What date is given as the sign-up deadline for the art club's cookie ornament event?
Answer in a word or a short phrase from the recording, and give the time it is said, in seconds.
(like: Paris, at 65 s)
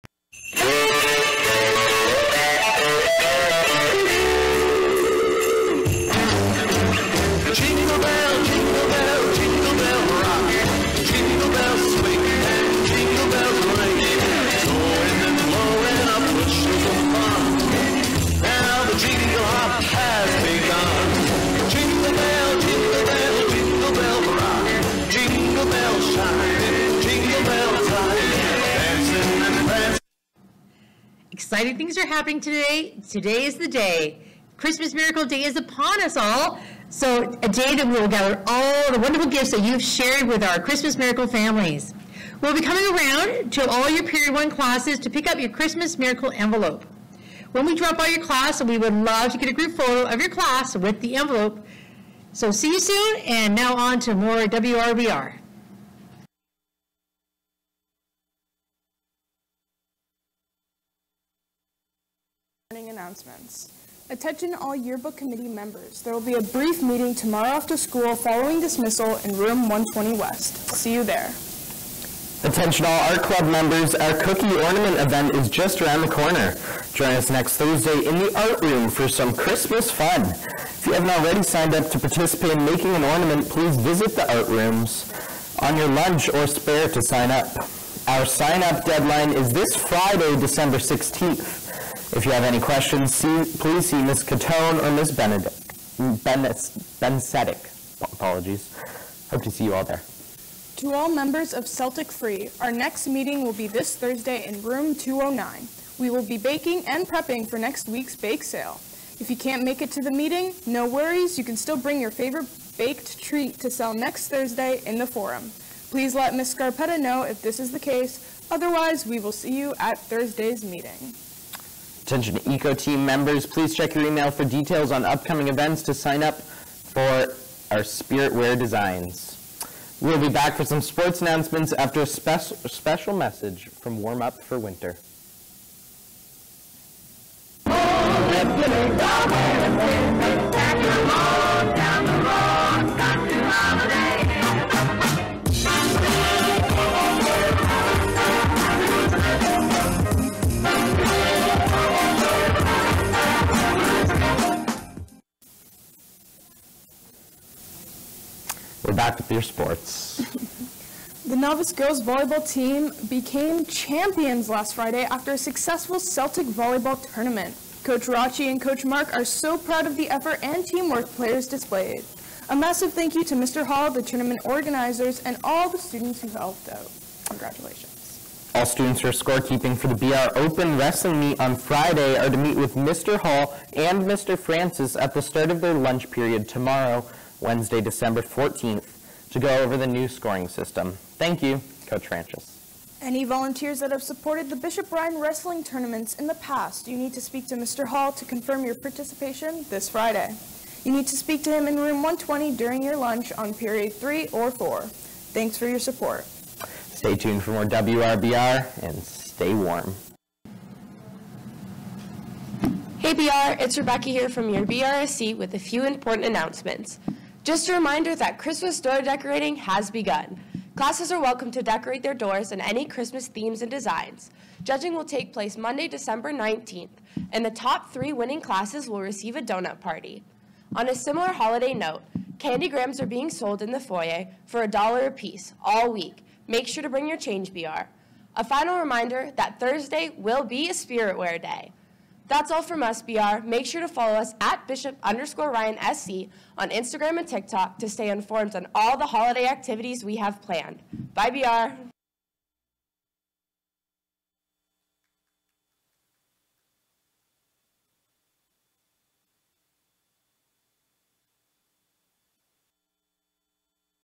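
Friday, December 16th, at 89 s.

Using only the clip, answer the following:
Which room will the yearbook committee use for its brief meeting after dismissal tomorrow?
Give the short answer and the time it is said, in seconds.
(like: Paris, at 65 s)
120 West, at 69 s.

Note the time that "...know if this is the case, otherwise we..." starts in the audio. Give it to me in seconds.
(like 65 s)
116 s.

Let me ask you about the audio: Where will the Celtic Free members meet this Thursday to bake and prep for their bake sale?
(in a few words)
Room 209.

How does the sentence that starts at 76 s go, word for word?
Join us next Thursday in the art room for some Christmas fun.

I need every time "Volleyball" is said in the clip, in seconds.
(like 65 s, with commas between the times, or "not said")
162 s, 166 s.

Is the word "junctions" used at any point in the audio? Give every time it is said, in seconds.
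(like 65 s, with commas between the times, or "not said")
not said.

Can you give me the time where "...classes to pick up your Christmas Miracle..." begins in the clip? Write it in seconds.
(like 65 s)
44 s.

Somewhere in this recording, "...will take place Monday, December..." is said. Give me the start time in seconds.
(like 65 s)
224 s.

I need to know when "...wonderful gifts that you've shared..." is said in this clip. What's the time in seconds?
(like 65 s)
38 s.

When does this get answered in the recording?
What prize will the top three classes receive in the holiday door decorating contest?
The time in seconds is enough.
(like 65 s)
229 s.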